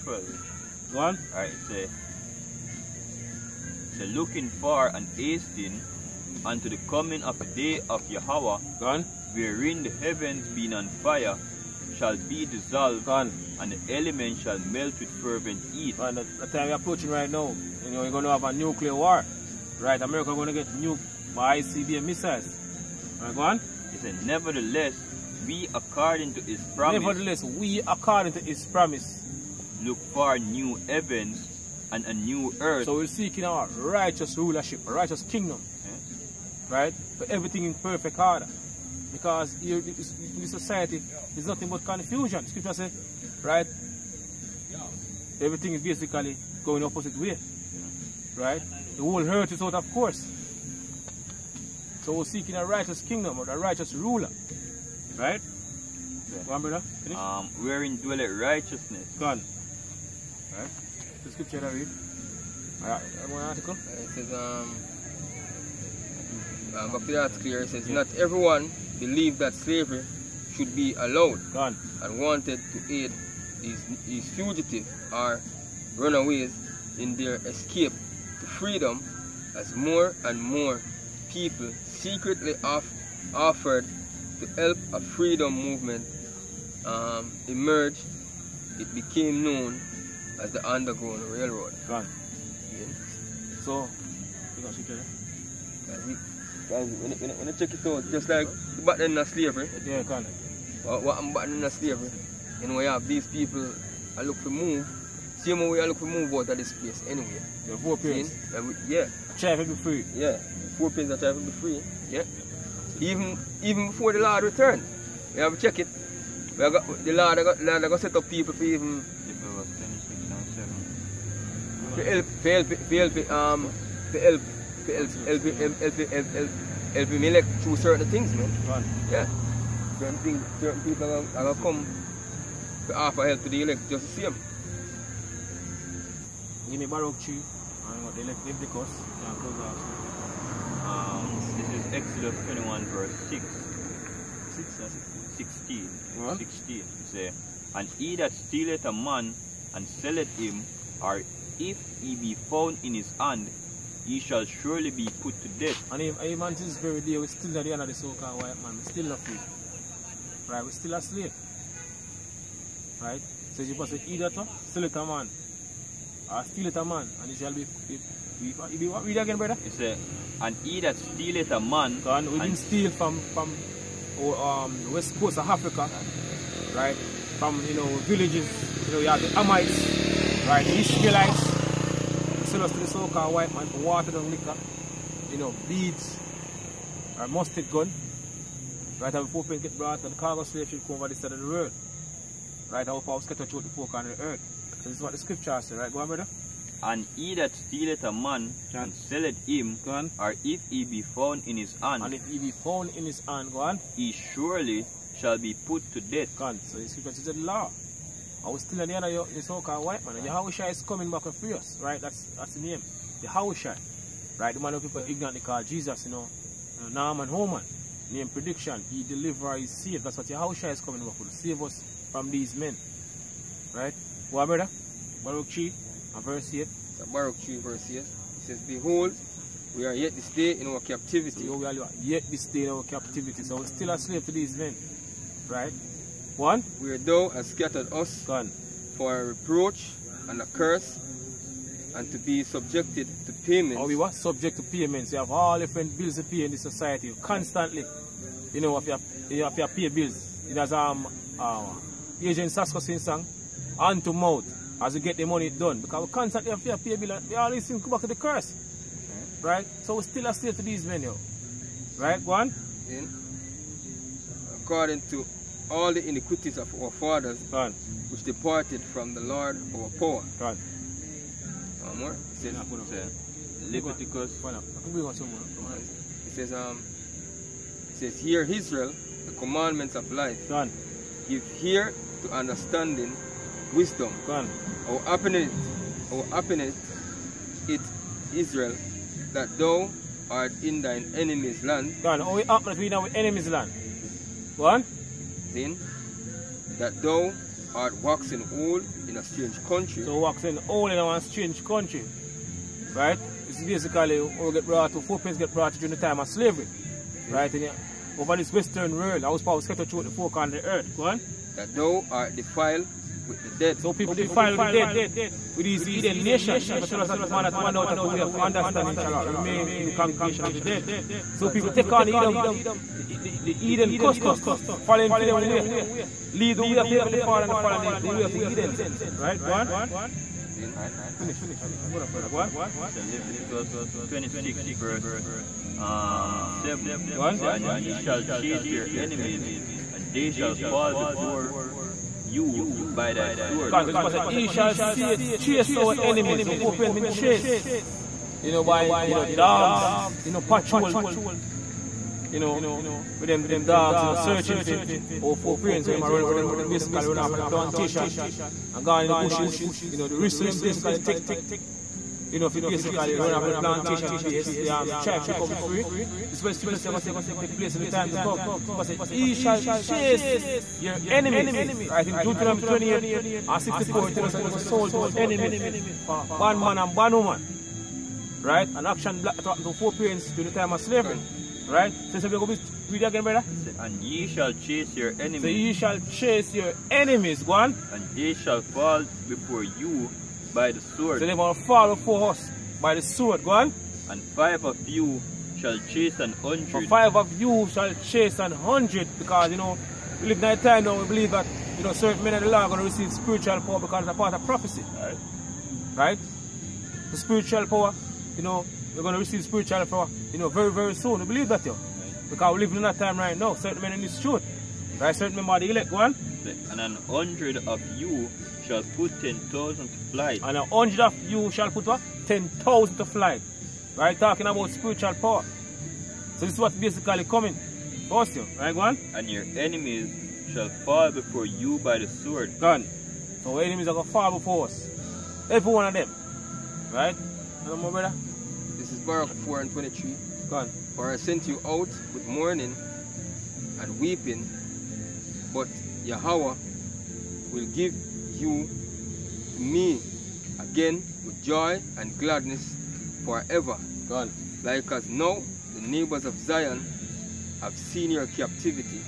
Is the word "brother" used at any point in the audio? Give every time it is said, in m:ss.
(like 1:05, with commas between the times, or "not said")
0:56, 2:49, 3:16, 3:44, 6:23, 7:17.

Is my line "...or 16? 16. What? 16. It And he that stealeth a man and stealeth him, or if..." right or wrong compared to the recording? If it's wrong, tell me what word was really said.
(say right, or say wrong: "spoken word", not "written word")
wrong: "selleth", not "stealeth".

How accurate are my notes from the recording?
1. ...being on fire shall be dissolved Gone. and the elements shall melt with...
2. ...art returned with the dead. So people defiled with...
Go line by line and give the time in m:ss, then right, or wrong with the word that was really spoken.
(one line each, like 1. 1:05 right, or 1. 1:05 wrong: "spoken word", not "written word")
1. 0:10 right
2. 5:12 wrong: "defiled", not "returned".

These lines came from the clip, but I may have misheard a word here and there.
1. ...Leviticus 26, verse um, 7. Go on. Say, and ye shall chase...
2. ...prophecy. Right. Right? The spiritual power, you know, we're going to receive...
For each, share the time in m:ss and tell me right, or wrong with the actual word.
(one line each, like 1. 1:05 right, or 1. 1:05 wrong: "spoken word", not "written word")
1. 5:33 right
2. 6:44 right.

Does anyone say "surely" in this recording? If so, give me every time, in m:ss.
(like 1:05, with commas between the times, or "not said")
2:34, 3:24.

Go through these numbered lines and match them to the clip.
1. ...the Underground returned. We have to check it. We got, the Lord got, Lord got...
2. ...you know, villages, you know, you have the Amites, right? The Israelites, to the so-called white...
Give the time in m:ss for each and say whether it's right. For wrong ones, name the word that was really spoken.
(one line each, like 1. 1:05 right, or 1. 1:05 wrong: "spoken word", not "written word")
1. 1:54 wrong: "Lord", not "Underground"
2. 2:57 right.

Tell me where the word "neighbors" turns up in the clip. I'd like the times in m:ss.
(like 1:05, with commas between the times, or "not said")
7:35.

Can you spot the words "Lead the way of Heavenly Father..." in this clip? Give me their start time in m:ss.
5:26.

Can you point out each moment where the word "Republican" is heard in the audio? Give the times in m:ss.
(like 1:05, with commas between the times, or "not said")
not said.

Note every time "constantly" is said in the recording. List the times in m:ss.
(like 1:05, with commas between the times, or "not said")
4:07, 4:16.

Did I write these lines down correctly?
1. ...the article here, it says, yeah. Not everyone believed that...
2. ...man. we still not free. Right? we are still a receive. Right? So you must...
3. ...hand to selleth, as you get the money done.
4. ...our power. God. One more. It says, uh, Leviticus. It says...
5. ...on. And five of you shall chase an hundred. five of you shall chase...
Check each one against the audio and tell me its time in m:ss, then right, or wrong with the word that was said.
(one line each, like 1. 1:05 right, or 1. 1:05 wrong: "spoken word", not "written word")
1. 1:07 right
2. 2:38 wrong: "slave", not "receive"
3. 4:13 wrong: "mouth", not "selleth"
4. 4:29 right
5. 6:33 right.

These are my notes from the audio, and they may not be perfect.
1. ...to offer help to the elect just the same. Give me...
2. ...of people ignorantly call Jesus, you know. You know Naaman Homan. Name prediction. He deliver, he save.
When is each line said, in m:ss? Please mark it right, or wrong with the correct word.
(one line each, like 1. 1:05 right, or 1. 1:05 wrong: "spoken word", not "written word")
1. 2:12 right
2. 3:34 right.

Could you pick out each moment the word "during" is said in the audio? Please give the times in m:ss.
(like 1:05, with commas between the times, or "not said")
5:05, 6:20.